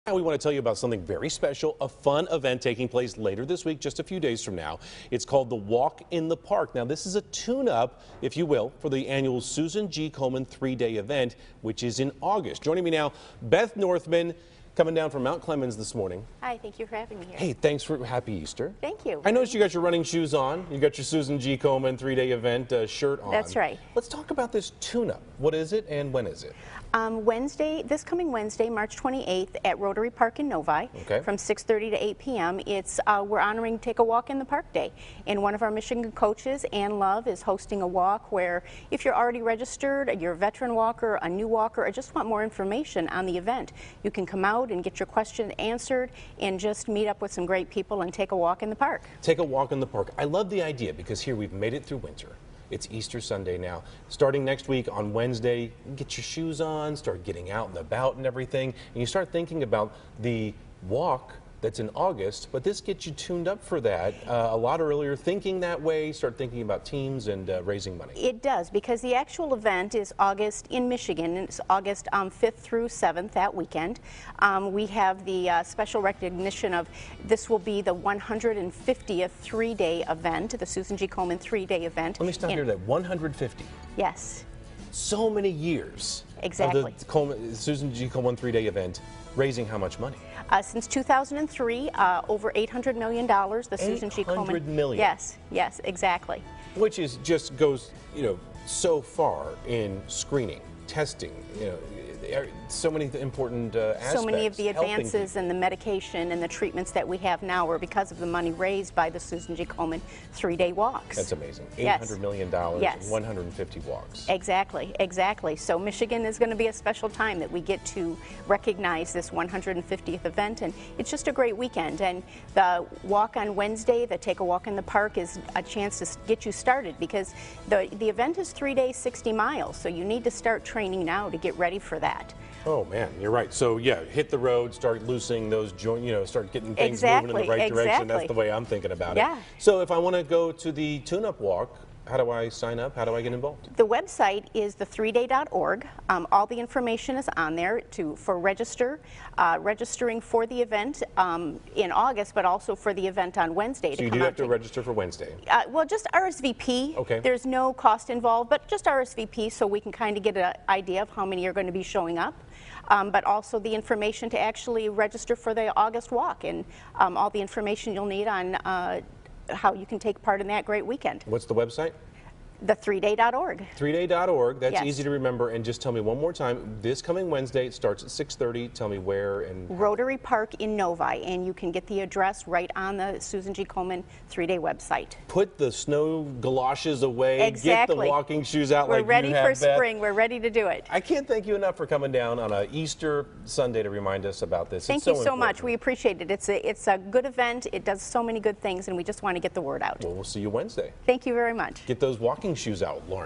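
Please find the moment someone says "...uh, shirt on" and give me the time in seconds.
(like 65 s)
22 s.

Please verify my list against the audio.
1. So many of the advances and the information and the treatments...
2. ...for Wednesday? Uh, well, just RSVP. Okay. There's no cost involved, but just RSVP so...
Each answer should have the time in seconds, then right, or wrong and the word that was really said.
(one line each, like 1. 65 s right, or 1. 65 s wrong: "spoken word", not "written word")
1. 104 s wrong: "medication", not "information"
2. 154 s right.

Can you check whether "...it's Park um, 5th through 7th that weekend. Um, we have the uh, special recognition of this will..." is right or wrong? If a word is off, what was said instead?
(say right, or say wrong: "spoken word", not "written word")
wrong: "August", not "Park".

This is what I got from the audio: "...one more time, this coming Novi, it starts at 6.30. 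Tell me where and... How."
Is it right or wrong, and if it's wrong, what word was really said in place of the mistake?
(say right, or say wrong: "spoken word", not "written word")
wrong: "Wednesday", not "Novi".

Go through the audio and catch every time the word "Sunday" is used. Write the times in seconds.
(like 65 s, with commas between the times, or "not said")
53 s, 193 s.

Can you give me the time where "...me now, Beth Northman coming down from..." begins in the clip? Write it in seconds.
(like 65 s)
12 s.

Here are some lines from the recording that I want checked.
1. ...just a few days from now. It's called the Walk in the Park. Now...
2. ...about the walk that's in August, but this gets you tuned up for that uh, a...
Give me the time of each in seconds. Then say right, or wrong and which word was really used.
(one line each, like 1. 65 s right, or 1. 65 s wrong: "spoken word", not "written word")
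1. 3 s right
2. 59 s right.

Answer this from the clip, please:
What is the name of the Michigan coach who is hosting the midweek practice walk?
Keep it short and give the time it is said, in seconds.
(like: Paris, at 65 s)
Ann Love, at 36 s.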